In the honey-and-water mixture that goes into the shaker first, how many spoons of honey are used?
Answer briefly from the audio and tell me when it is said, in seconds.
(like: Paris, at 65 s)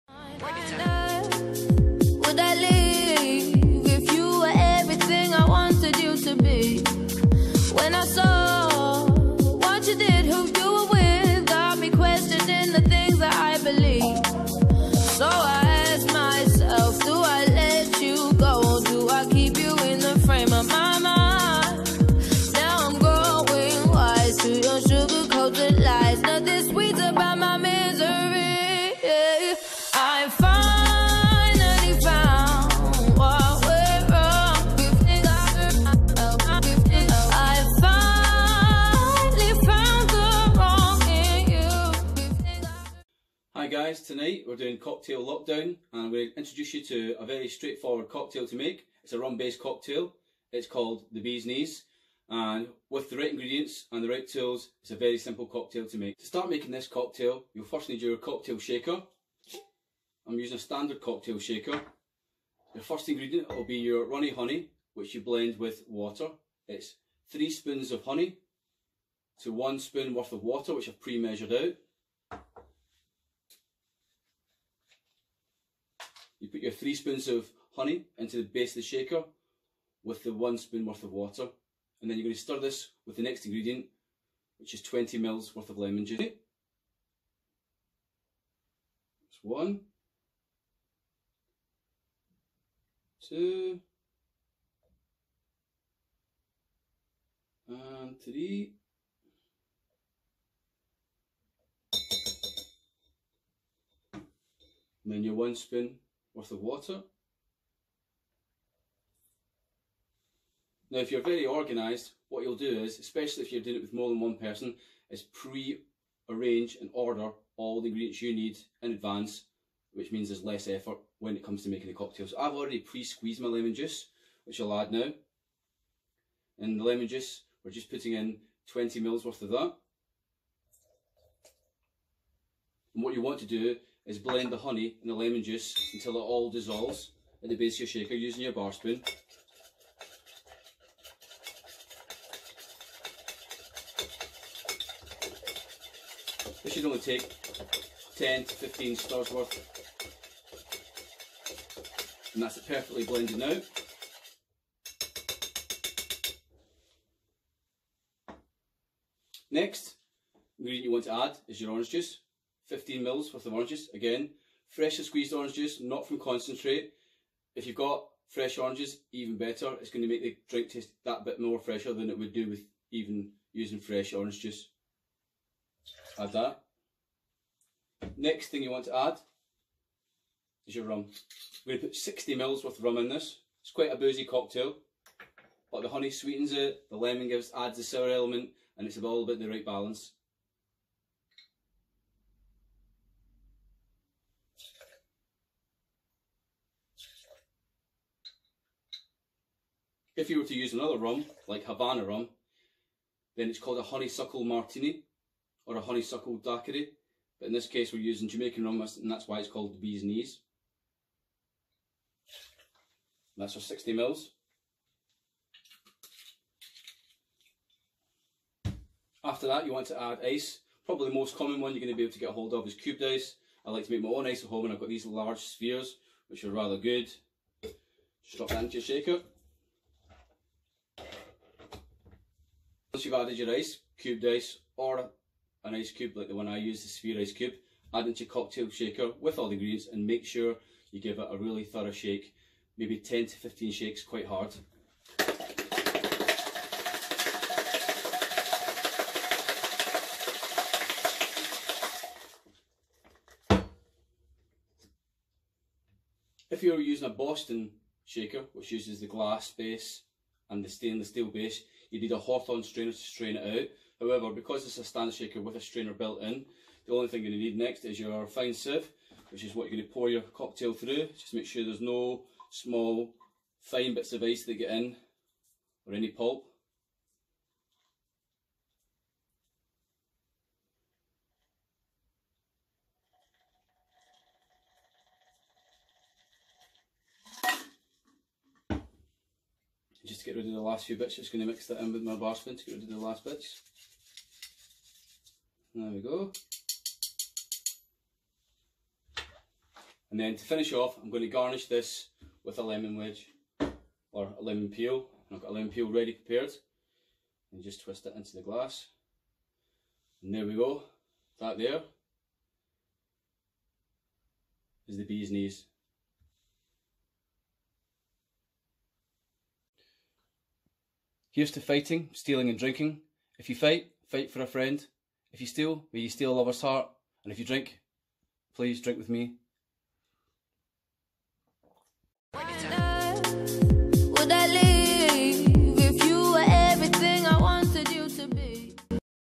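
3, at 67 s.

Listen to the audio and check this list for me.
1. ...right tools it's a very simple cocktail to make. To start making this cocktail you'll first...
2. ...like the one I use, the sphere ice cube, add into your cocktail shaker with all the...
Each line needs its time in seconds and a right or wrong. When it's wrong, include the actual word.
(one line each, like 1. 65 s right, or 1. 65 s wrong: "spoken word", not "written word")
1. 54 s right
2. 236 s right.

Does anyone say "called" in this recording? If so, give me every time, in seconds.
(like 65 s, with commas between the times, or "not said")
50 s, 203 s, 209 s.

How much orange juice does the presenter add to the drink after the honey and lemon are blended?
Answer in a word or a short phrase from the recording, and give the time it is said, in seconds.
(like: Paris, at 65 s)
15 ml, at 162 s.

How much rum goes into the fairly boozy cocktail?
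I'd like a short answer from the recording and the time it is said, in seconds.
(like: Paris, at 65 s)
60 ml, at 181 s.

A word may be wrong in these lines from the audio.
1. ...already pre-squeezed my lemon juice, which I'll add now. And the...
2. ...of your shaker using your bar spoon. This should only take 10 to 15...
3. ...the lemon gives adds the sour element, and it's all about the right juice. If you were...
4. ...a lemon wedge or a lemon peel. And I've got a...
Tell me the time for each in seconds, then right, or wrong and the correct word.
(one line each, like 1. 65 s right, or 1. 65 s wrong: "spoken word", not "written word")
1. 122 s right
2. 137 s right
3. 186 s wrong: "balance", not "juice"
4. 302 s right.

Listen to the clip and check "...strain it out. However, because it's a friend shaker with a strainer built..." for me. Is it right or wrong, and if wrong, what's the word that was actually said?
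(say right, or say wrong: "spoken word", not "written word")
wrong: "stand", not "friend".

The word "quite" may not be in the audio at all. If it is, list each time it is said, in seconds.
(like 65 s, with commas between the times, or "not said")
183 s, 244 s.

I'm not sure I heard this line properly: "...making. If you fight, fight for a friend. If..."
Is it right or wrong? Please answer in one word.
wrong.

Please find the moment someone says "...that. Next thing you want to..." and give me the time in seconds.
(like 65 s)
176 s.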